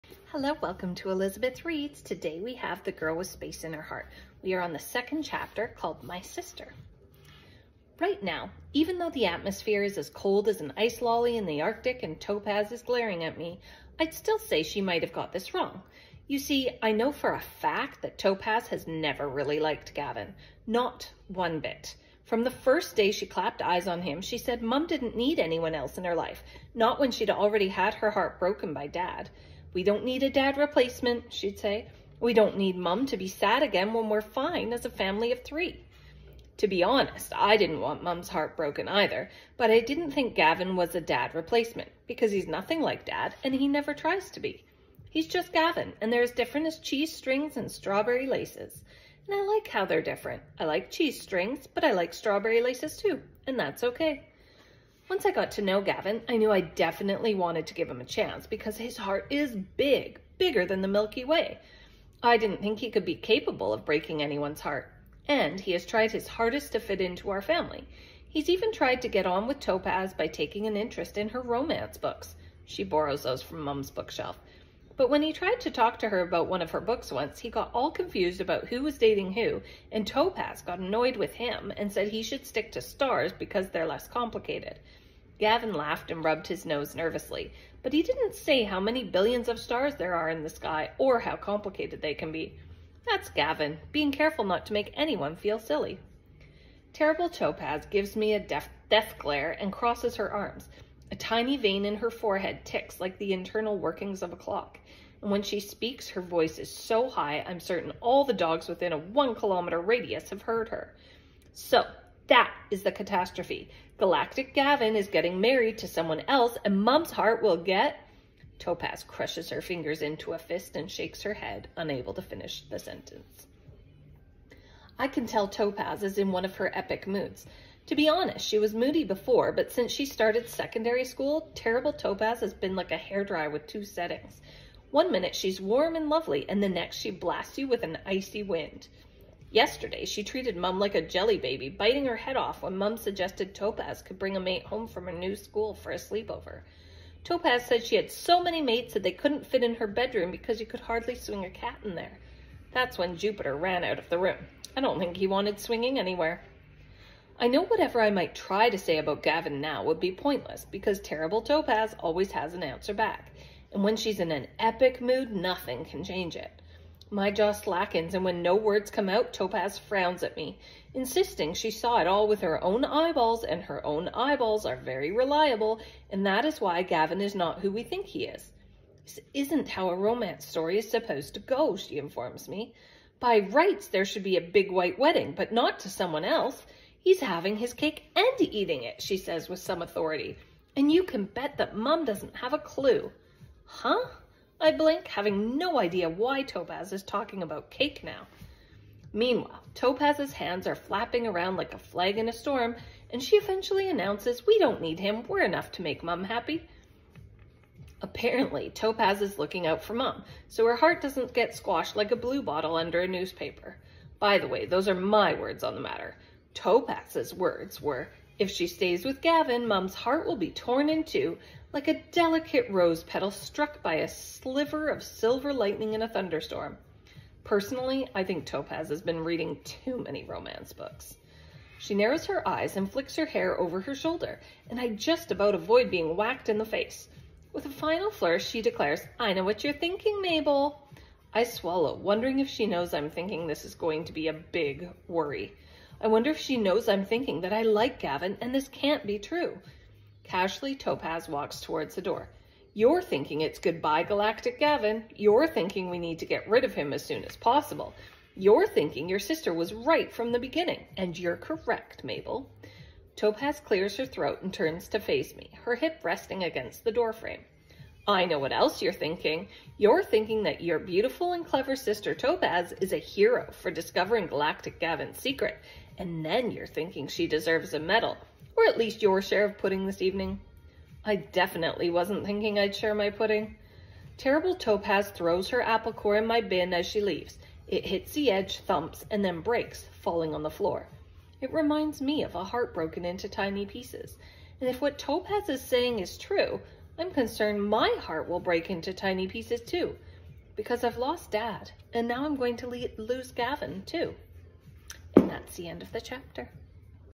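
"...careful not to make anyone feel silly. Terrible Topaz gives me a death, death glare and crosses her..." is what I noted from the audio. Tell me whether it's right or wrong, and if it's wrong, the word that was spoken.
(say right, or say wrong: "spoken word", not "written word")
right.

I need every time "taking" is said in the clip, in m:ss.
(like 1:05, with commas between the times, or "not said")
1:10.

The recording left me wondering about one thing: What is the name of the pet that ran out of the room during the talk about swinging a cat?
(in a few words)
Jupiter.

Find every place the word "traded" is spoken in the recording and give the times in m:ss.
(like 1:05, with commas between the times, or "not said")
not said.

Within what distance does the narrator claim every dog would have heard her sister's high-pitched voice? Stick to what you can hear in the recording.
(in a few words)
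1 kilometer.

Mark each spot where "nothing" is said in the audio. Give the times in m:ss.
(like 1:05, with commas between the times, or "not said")
0:42, 2:45.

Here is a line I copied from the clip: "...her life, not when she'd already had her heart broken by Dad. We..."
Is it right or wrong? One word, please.
right.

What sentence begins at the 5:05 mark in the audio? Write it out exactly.
And that's the end of the chapter.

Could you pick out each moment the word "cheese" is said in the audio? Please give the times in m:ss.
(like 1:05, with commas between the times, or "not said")
0:46, 0:50.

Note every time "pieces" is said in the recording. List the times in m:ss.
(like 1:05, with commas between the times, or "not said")
4:53, 4:59.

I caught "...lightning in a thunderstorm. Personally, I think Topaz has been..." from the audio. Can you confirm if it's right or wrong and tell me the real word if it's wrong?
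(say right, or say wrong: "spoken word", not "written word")
right.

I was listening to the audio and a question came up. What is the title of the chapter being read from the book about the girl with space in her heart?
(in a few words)
My Sister.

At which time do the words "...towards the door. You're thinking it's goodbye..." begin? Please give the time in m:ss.
4:11.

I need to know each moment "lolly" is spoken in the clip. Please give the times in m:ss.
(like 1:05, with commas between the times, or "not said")
0:11.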